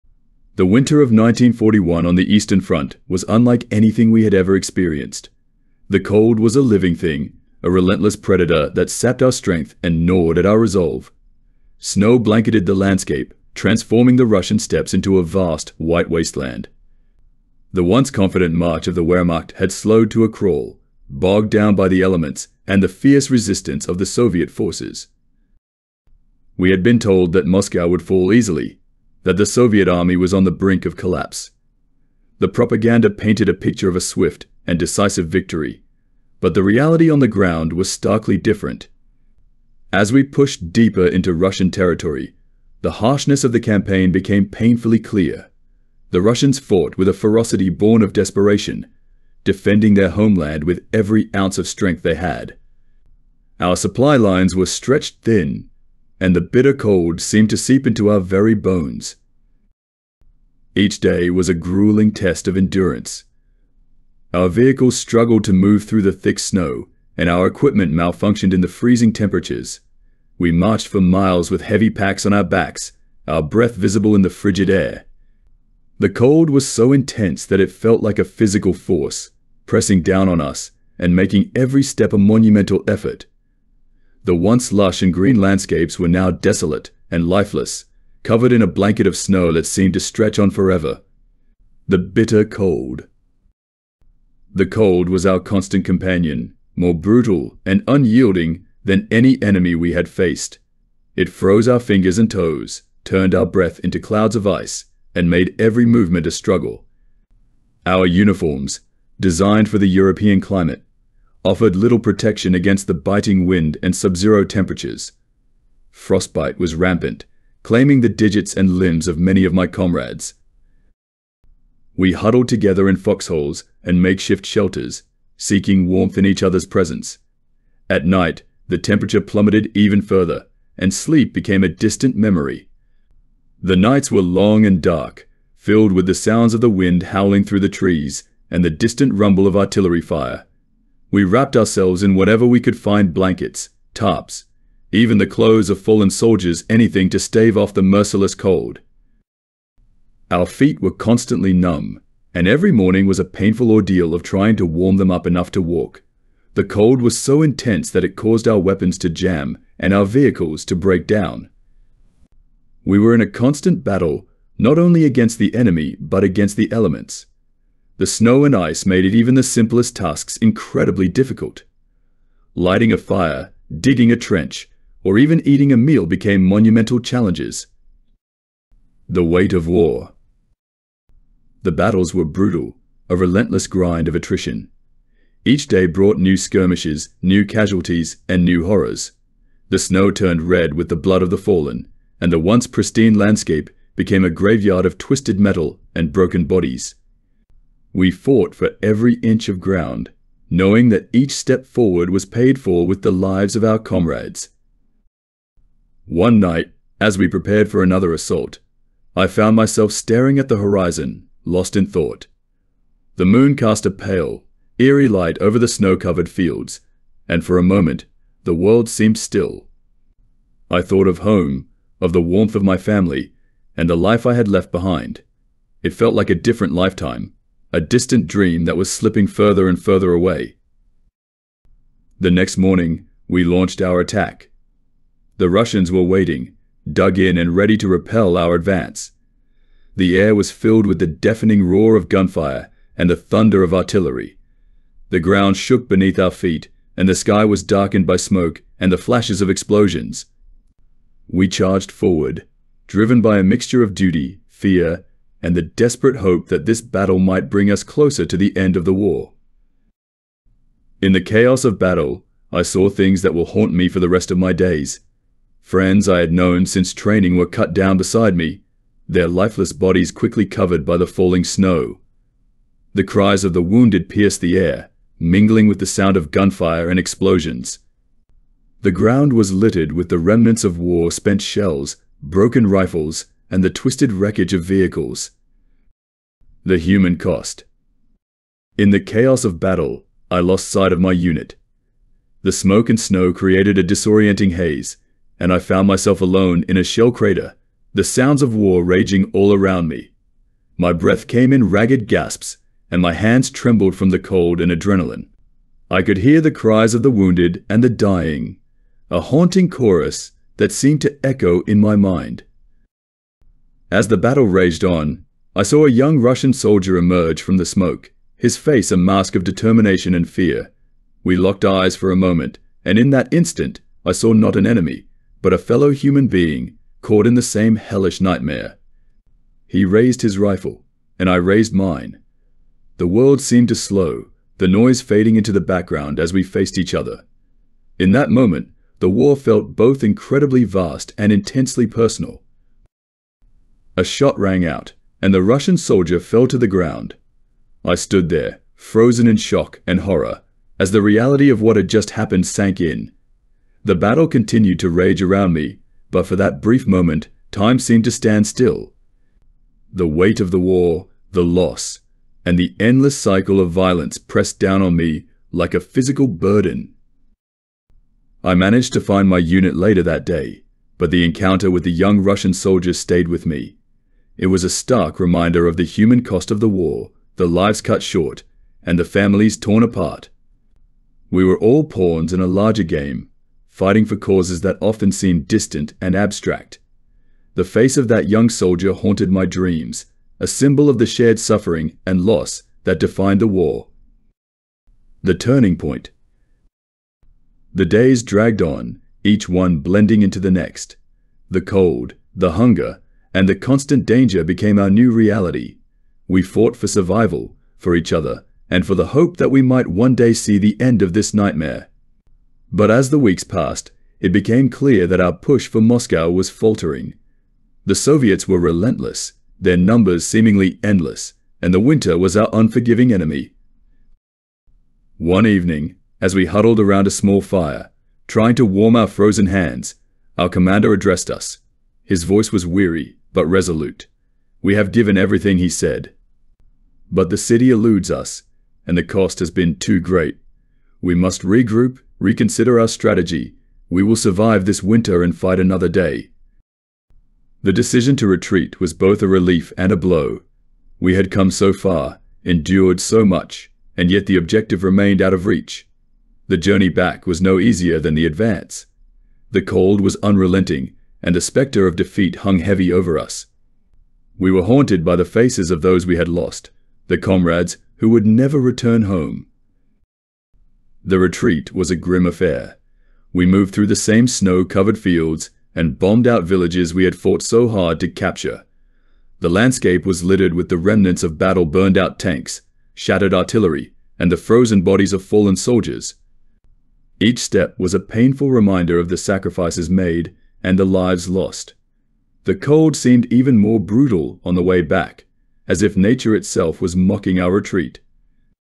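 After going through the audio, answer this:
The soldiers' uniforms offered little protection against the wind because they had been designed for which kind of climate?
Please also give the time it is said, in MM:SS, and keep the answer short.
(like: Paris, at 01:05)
European climate, at 01:49.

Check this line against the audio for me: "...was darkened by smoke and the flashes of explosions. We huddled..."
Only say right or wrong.
wrong.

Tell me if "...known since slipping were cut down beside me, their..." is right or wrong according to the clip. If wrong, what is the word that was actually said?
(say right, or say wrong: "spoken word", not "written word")
wrong: "training", not "slipping".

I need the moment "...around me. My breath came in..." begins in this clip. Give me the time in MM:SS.
04:59.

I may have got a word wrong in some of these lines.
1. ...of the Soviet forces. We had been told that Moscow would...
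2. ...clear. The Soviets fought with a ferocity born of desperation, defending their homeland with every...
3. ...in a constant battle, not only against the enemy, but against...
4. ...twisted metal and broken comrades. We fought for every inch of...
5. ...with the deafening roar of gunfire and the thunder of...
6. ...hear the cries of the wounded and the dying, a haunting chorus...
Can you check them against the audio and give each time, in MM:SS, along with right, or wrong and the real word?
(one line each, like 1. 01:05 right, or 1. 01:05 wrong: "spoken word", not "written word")
1. 00:23 right
2. 00:44 wrong: "Russians", not "Soviets"
3. 02:43 right
4. 03:14 wrong: "bodies", not "comrades"
5. 04:00 right
6. 05:06 right.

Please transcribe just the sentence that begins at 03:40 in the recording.
I thought of home, of the warmth of my family, and the life I had left behind.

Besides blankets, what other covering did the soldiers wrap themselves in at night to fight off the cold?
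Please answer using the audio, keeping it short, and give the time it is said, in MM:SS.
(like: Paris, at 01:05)
Tarps, at 02:23.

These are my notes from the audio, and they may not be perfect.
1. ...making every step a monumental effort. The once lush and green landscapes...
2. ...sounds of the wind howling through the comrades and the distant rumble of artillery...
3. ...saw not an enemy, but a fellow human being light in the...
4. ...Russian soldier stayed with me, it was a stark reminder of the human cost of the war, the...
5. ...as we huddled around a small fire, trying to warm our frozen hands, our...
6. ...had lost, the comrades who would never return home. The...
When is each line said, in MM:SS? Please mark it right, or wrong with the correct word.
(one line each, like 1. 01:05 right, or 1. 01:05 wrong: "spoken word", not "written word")
1. 01:21 right
2. 02:16 wrong: "trees", not "comrades"
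3. 05:24 wrong: "caught", not "light"
4. 06:12 right
5. 07:06 right
6. 07:46 right.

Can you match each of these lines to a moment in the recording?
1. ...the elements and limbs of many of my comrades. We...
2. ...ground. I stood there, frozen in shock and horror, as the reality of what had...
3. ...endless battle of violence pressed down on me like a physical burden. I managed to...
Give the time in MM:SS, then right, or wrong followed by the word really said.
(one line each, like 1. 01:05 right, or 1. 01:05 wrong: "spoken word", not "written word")
1. 01:58 wrong: "digits", not "elements"
2. 05:46 right
3. 06:02 wrong: "cycle", not "battle".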